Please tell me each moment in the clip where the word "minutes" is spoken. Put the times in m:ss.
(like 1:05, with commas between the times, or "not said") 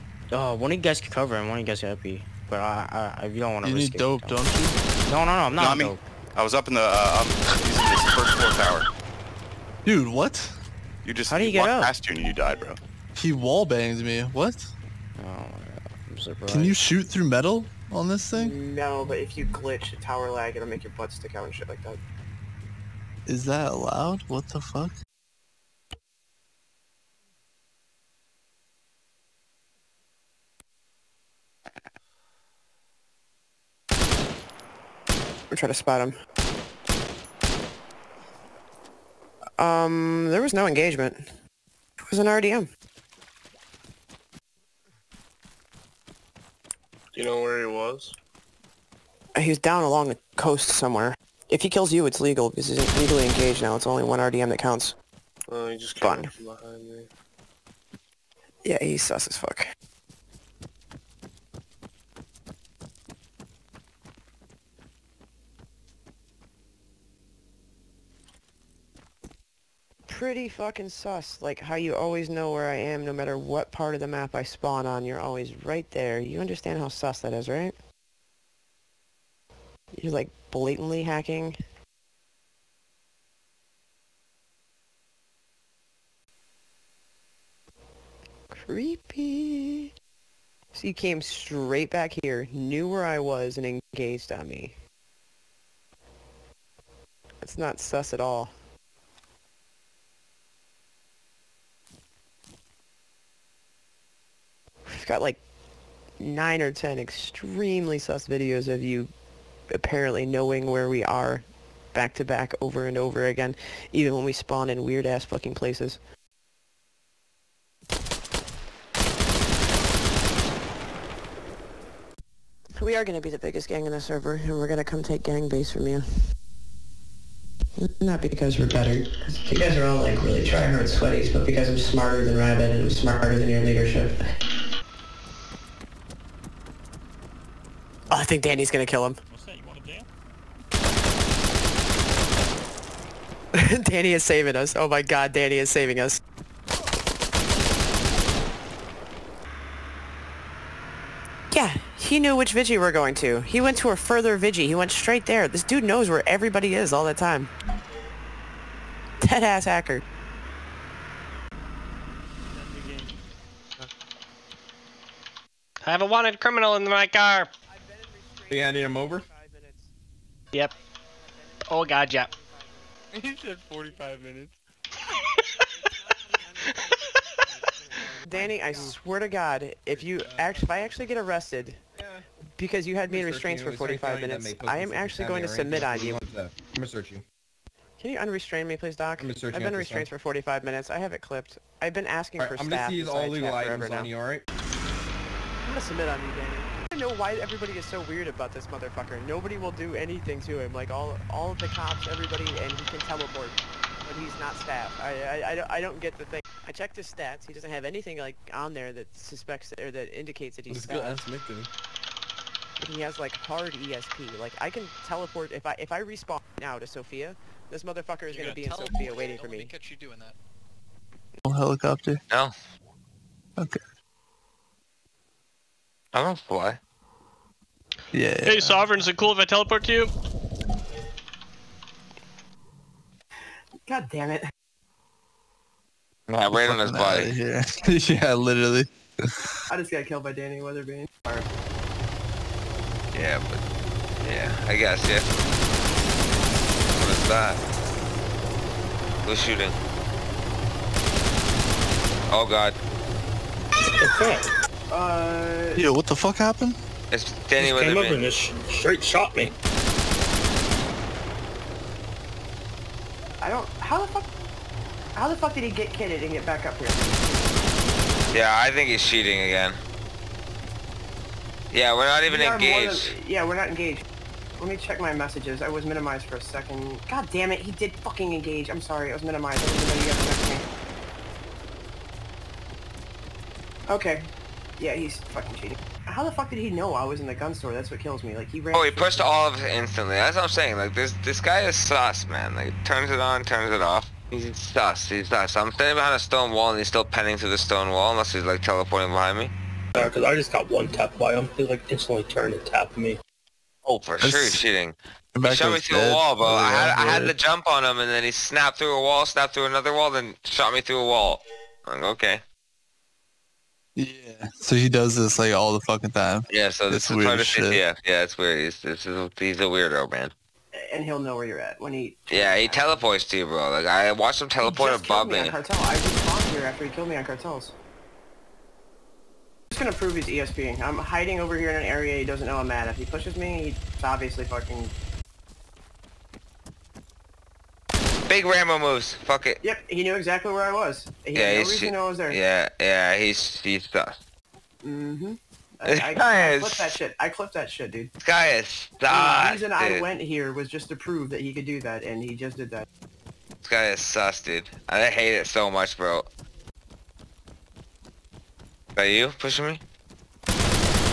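2:54, 3:04, 3:10.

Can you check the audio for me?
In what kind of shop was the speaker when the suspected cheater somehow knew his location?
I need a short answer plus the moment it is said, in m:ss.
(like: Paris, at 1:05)
gun store, at 4:47.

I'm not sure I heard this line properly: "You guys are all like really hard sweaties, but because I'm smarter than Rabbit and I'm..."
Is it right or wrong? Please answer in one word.
right.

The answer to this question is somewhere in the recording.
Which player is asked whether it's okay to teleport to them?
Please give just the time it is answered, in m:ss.
3:48.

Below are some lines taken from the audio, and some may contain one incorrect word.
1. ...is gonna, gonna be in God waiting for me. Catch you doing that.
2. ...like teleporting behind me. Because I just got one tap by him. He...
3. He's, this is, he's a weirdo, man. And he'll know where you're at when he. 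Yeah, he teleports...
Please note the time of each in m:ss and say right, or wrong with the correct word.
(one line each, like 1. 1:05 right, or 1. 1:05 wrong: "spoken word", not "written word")
1. 3:38 wrong: "Sofia", not "God"
2. 4:58 right
3. 5:18 right.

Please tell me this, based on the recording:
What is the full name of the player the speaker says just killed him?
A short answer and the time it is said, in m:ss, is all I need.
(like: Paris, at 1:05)
Danny Weatherbee, at 4:00.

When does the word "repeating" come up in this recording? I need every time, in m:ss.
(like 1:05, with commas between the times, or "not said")
not said.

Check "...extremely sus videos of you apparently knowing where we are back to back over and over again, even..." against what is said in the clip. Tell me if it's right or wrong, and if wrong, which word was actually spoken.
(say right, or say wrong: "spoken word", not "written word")
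right.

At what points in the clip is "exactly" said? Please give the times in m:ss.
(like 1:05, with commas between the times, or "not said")
5:40.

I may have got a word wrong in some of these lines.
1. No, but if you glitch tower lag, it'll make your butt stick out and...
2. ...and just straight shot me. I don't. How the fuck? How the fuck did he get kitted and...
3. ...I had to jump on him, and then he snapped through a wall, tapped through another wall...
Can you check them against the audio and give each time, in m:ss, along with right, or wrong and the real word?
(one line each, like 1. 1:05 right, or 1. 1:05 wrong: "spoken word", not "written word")
1. 0:18 right
2. 4:18 right
3. 5:06 wrong: "snapped", not "tapped".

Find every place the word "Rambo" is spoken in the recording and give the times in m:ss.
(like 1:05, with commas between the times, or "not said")
5:38.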